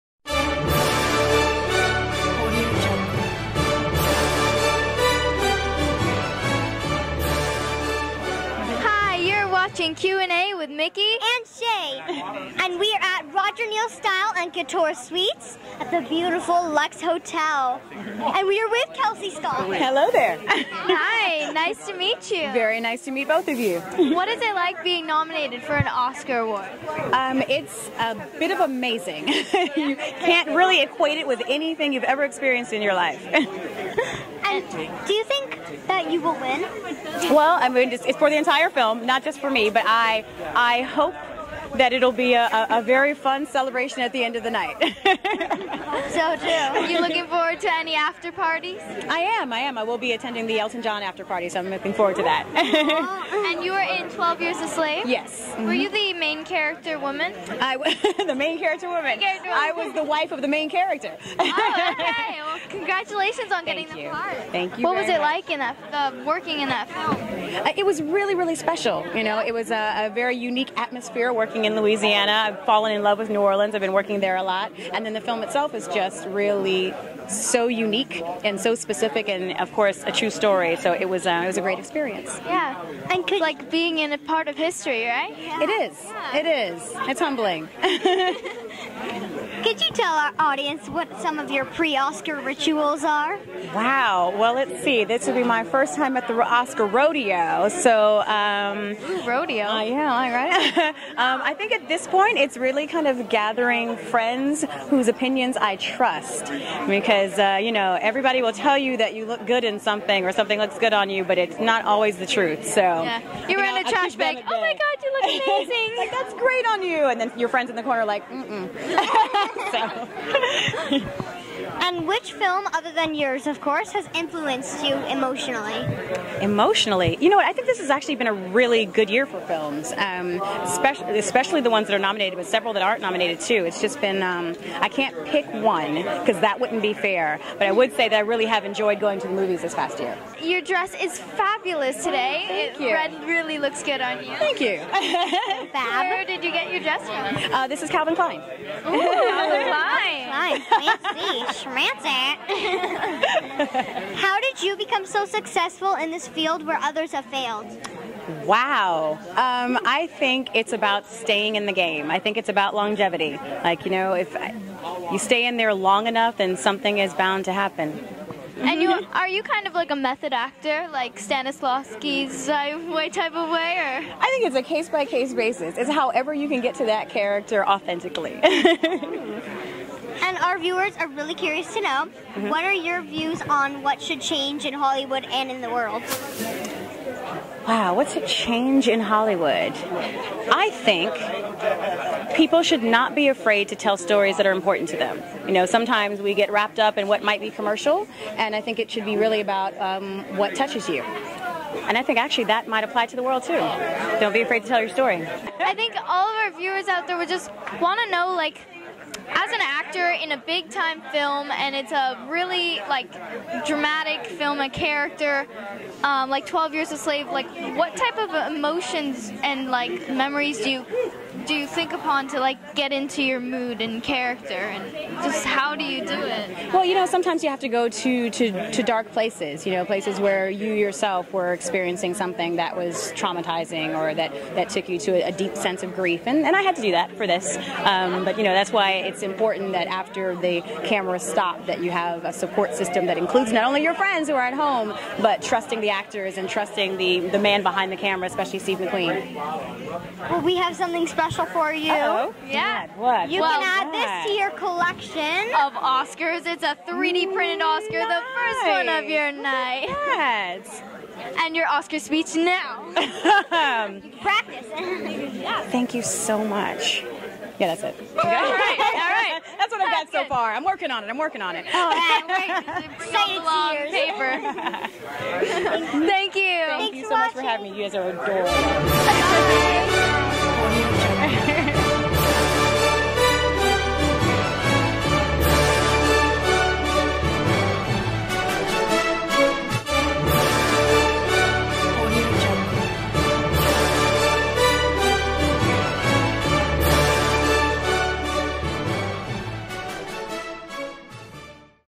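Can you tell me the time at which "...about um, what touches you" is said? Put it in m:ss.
3:19.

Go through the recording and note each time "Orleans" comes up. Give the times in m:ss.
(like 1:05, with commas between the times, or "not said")
1:13.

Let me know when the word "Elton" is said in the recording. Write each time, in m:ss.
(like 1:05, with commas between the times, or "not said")
0:50.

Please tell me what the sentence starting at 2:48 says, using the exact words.
And you are you kind of like a method actor, like Stanislavski's way type of way, or?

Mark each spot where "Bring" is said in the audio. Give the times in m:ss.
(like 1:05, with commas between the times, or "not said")
4:32.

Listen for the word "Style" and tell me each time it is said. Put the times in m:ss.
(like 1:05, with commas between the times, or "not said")
0:13.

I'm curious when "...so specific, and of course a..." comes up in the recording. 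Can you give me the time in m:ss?
1:18.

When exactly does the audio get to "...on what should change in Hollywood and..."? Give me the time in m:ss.
3:03.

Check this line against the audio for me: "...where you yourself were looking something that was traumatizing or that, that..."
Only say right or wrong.
wrong.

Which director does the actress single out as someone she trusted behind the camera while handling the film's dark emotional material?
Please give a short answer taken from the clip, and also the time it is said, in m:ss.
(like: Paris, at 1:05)
Steve McQueen, at 4:08.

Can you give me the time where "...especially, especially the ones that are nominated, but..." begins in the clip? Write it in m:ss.
2:10.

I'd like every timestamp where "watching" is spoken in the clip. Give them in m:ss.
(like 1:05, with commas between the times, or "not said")
0:09.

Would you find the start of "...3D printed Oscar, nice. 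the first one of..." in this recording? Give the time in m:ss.
4:16.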